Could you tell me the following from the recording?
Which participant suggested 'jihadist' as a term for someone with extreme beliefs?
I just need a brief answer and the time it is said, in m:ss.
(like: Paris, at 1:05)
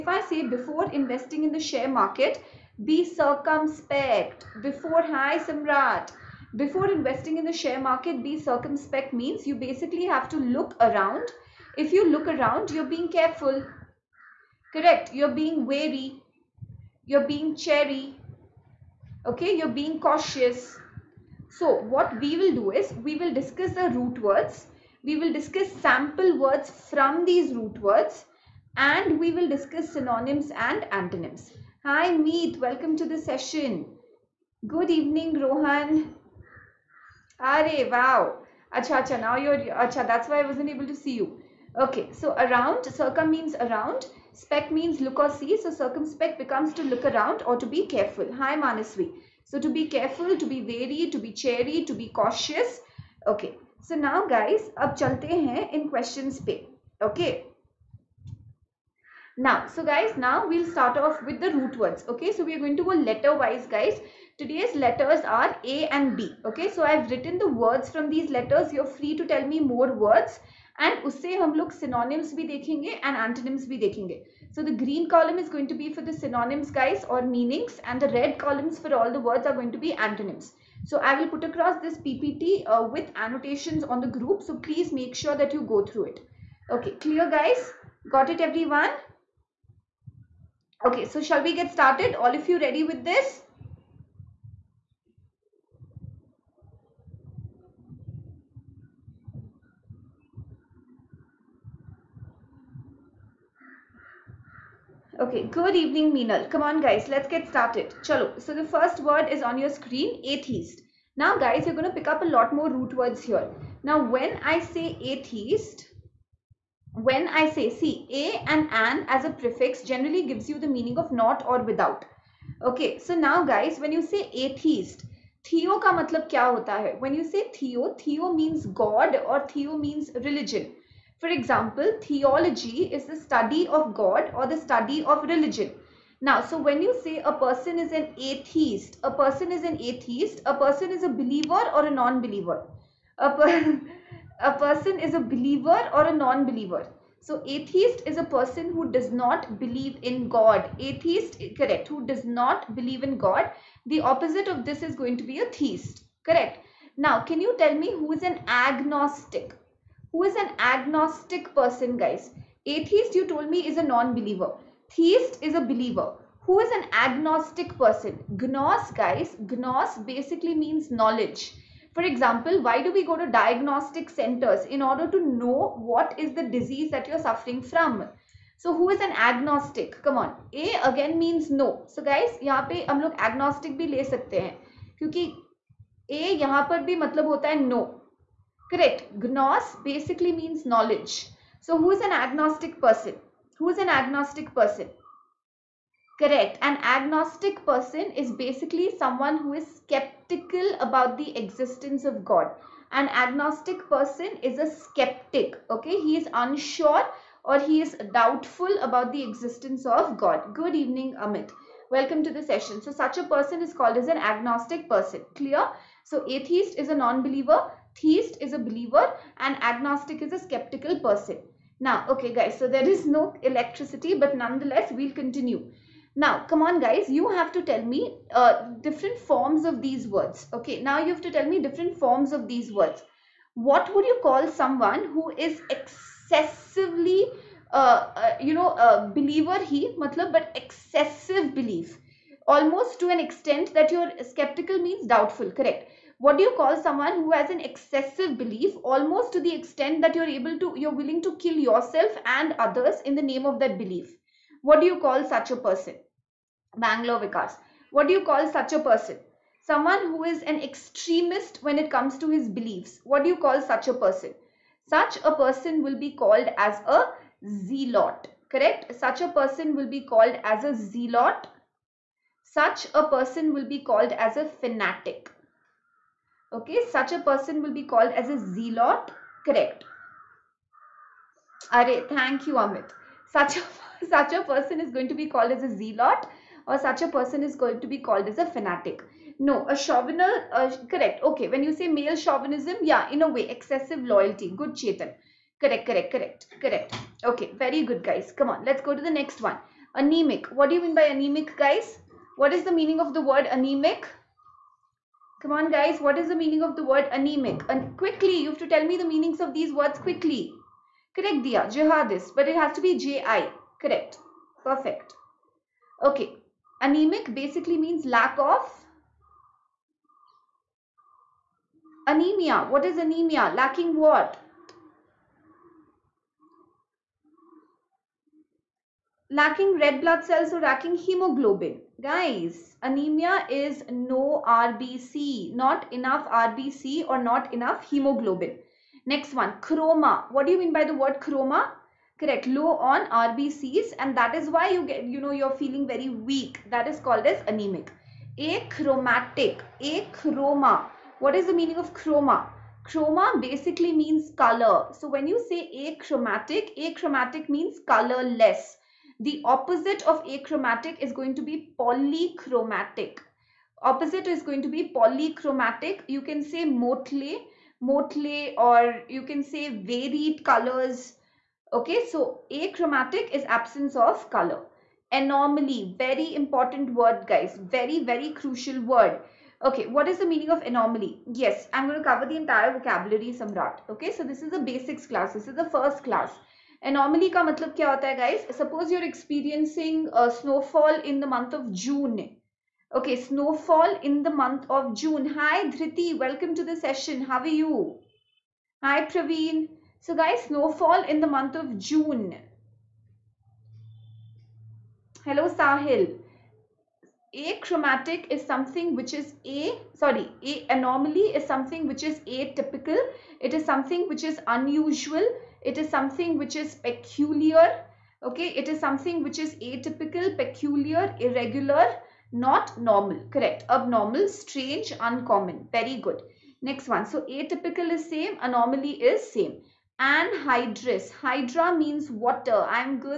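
Dia, at 5:11.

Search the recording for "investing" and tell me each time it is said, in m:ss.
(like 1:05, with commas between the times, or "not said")
0:01, 0:06.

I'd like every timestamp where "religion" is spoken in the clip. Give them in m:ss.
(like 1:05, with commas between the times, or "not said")
2:10, 2:15.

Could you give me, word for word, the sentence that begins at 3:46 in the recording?
Now, come on guys, you have to tell me uh, different forms of these words.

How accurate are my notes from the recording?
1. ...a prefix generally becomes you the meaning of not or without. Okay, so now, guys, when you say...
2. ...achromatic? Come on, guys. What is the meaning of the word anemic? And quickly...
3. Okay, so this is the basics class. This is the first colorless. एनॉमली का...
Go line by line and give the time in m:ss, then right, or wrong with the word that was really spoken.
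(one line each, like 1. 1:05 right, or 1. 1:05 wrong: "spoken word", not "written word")
1. 1:59 wrong: "gives", not "becomes"
2. 5:03 wrong: "anemic", not "achromatic"
3. 6:23 wrong: "class", not "colorless".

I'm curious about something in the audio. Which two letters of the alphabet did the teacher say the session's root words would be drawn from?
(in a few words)
A and B.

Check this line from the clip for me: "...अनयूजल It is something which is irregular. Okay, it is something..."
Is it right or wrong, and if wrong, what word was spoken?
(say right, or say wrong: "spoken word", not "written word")
wrong: "peculiar", not "irregular".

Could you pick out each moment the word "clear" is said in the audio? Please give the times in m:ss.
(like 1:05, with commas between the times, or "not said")
1:27, 3:35.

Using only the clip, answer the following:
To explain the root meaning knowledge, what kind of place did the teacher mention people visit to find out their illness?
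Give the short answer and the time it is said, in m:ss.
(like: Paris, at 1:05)
diagnostic centers, at 2:53.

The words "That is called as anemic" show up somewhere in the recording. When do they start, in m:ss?
5:46.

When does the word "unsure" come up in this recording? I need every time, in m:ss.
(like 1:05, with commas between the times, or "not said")
3:26.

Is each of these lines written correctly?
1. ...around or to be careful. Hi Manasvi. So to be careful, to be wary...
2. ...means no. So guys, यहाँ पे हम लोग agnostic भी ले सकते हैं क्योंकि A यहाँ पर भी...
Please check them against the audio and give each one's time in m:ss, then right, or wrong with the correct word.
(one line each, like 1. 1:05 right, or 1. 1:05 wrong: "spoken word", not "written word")
1. 0:47 right
2. 3:01 right.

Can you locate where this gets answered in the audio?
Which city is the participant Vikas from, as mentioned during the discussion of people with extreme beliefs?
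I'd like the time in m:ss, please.
4:16.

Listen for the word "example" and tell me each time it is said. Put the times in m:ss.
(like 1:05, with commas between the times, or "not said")
2:11, 2:52.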